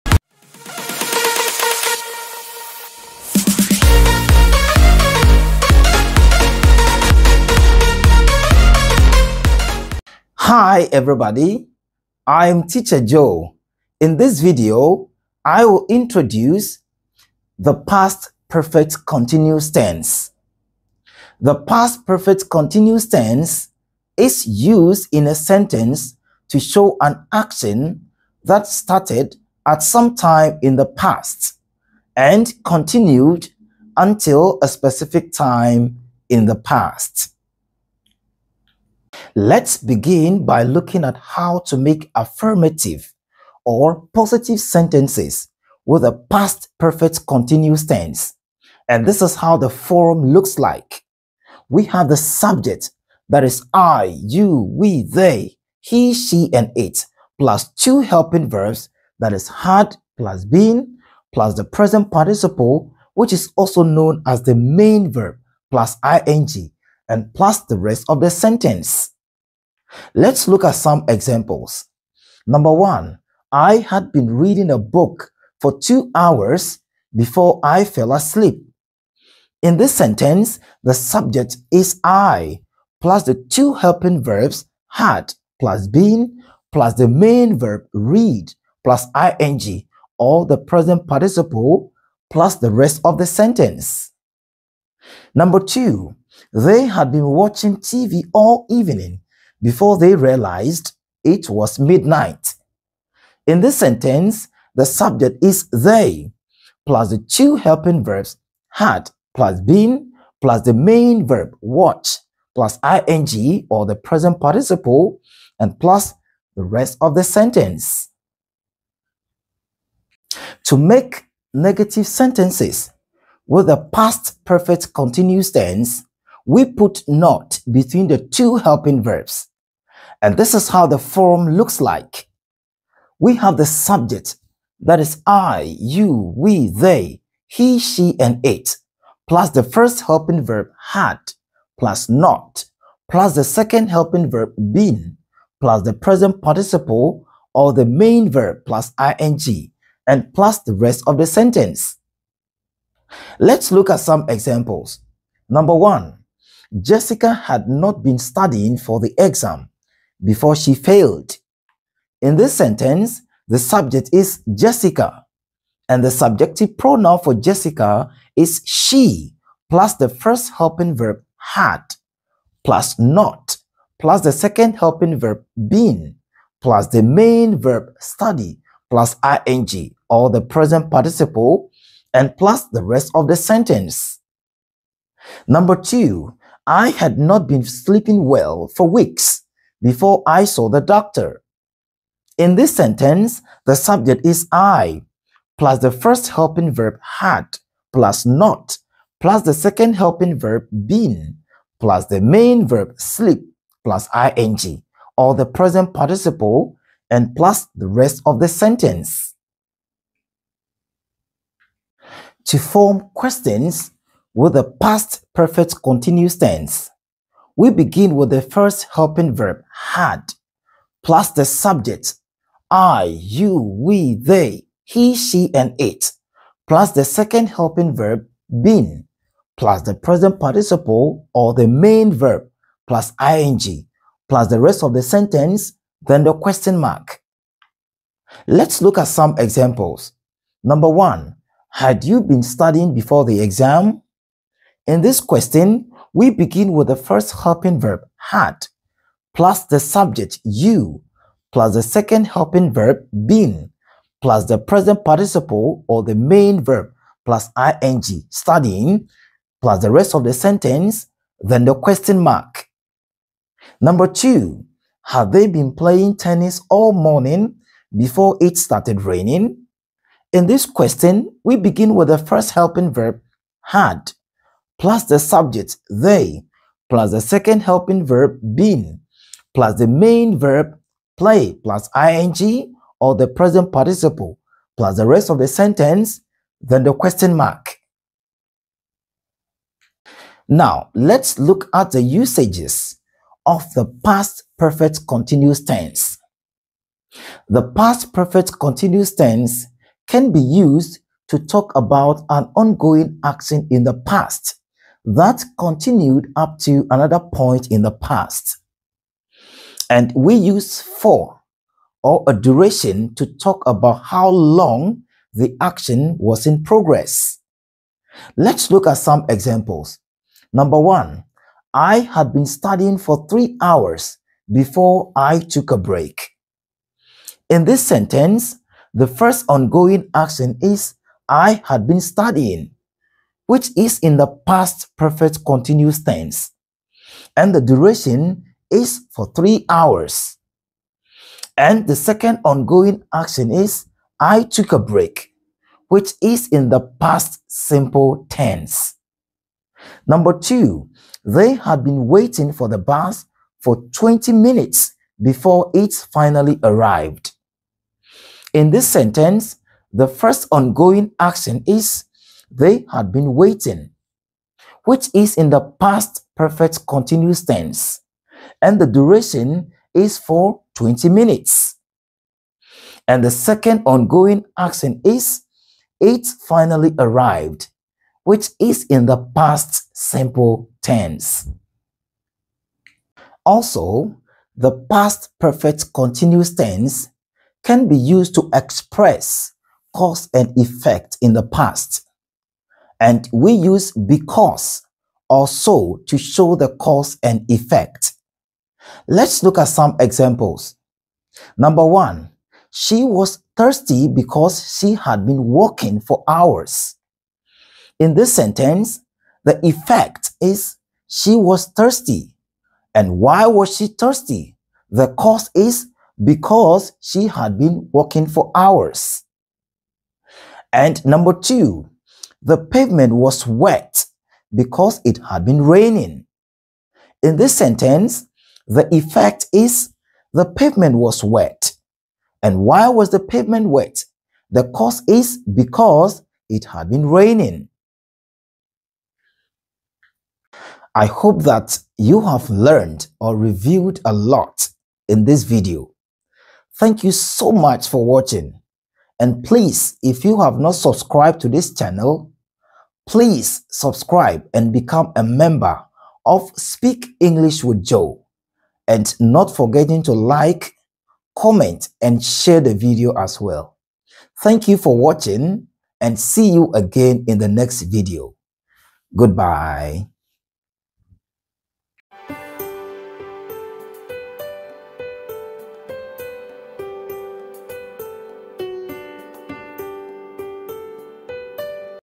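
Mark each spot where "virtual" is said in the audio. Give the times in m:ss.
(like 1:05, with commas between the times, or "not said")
not said.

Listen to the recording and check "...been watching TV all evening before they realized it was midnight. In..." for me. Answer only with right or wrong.
right.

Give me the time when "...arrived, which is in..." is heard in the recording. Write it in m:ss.
6:16.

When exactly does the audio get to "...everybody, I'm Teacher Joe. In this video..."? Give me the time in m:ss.
0:10.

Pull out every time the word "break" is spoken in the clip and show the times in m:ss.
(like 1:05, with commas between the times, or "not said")
5:25, 5:44.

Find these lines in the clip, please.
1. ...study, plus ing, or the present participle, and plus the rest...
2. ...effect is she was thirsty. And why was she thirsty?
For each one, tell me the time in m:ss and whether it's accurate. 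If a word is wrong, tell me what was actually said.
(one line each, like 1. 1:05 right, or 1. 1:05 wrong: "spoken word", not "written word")
1. 2:57 right
2. 6:49 right.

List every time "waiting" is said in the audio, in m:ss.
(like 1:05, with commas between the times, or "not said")
5:52, 6:03.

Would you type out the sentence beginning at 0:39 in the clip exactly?
Let's begin by looking at how to make affirmative or positive sentences with a past perfect continuous tense.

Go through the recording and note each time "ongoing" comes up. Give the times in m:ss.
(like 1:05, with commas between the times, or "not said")
5:02, 5:29, 5:42, 6:00, 6:13.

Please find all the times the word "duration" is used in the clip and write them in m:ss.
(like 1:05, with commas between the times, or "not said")
5:12, 5:37, 6:08.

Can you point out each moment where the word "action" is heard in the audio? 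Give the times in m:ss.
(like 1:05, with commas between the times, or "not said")
0:27, 5:03, 5:15, 5:30, 5:43, 6:01, 6:14.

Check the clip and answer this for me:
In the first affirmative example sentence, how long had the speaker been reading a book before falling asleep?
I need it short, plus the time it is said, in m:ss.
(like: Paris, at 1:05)
2 hours, at 1:15.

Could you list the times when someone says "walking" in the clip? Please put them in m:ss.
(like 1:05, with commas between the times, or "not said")
6:45, 6:57.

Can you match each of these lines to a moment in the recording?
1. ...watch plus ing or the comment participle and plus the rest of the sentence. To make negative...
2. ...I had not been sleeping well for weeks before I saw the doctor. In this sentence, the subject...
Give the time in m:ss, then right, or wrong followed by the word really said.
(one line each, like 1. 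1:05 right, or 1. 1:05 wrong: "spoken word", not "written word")
1. 1:51 wrong: "present", not "comment"
2. 3:06 right.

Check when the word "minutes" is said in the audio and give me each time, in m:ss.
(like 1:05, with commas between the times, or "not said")
5:54, 6:11.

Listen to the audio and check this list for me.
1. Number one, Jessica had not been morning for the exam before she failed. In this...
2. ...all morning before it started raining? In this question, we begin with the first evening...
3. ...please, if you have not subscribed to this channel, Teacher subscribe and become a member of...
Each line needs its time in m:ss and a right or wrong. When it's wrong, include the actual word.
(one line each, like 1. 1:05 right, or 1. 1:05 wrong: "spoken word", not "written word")
1. 2:35 wrong: "studying", not "morning"
2. 4:26 wrong: "helping", not "evening"
3. 7:29 wrong: "Please", not "Teacher".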